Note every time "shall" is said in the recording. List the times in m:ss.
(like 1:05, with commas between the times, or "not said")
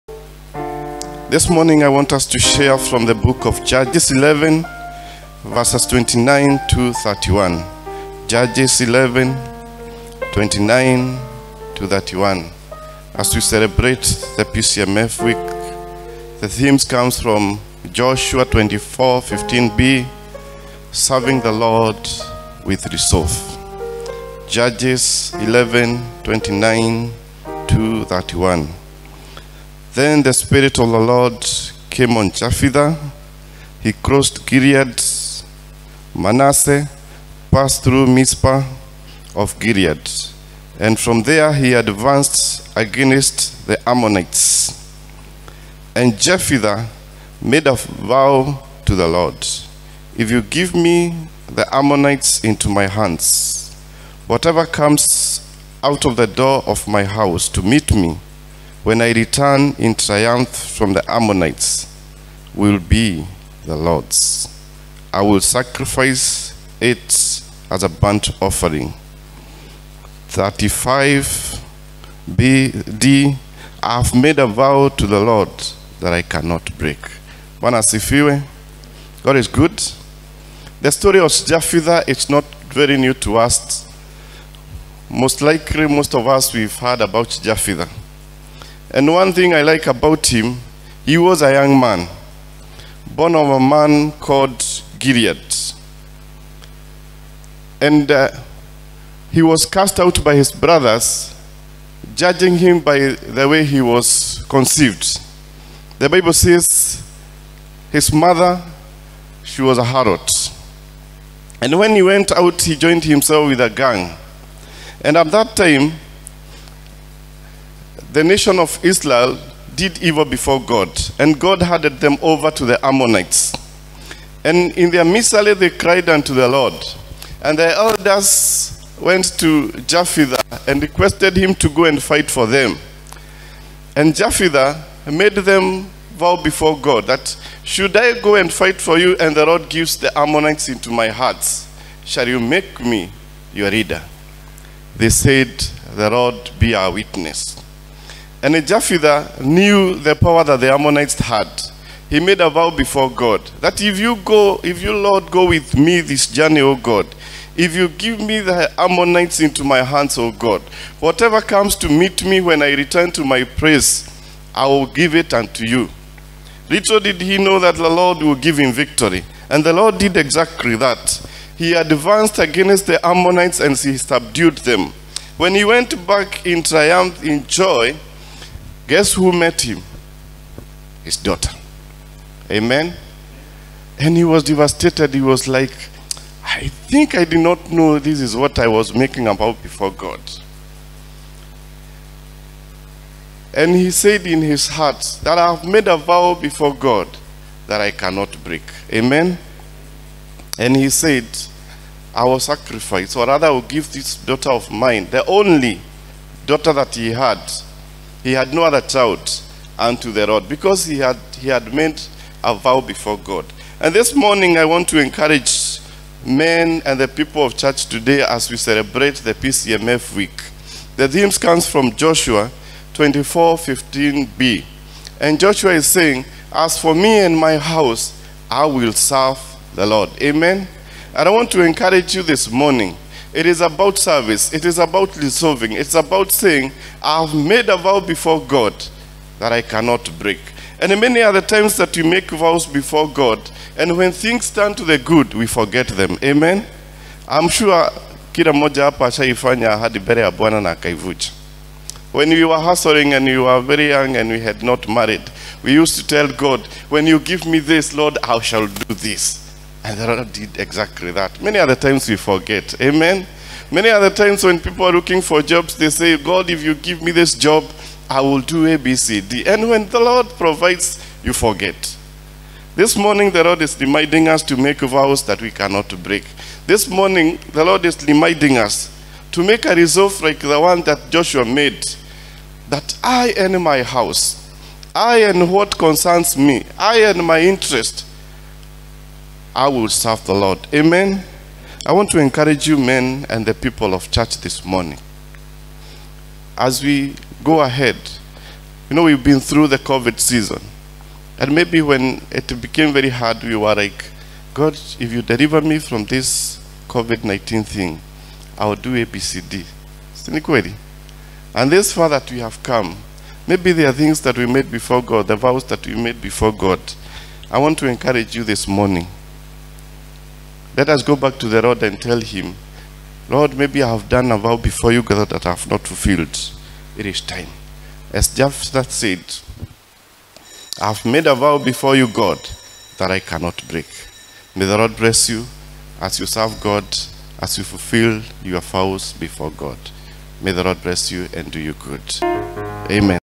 2:22, 4:18.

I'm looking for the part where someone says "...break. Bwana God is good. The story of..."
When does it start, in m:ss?
1:16.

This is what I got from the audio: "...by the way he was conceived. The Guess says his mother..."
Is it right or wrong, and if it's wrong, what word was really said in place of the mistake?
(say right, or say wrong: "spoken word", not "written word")
wrong: "Bible", not "Guess".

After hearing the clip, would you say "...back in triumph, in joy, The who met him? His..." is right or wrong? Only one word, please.
wrong.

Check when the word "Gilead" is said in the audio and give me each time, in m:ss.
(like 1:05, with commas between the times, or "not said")
0:34, 0:39, 1:34.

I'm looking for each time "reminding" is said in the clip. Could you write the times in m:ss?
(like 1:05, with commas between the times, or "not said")
4:33, 4:38.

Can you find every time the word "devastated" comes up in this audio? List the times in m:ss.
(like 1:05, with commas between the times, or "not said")
3:04.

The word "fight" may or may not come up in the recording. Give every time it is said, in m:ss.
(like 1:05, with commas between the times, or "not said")
2:12, 2:18.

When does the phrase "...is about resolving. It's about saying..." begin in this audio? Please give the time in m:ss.
3:54.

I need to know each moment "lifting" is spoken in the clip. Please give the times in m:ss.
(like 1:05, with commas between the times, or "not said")
not said.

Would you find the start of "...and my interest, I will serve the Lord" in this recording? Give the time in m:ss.
4:47.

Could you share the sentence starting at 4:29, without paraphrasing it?
And when the Lord provides, you forget.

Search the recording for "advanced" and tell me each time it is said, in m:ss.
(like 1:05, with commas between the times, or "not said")
0:41, 2:51.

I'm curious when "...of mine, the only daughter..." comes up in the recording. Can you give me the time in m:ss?
3:24.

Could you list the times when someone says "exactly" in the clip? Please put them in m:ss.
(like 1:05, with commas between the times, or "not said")
2:50, 4:20.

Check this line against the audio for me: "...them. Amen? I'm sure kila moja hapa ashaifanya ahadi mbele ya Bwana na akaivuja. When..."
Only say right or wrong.
right.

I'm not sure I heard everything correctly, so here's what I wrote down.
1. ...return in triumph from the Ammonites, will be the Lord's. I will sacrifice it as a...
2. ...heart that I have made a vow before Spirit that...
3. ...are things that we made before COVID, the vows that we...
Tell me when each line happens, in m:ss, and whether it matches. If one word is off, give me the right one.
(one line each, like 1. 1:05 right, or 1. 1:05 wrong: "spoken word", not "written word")
1. 0:59 right
2. 3:14 wrong: "God", not "Spirit"
3. 5:13 wrong: "God", not "COVID".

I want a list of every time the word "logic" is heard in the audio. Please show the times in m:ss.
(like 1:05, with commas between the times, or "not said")
not said.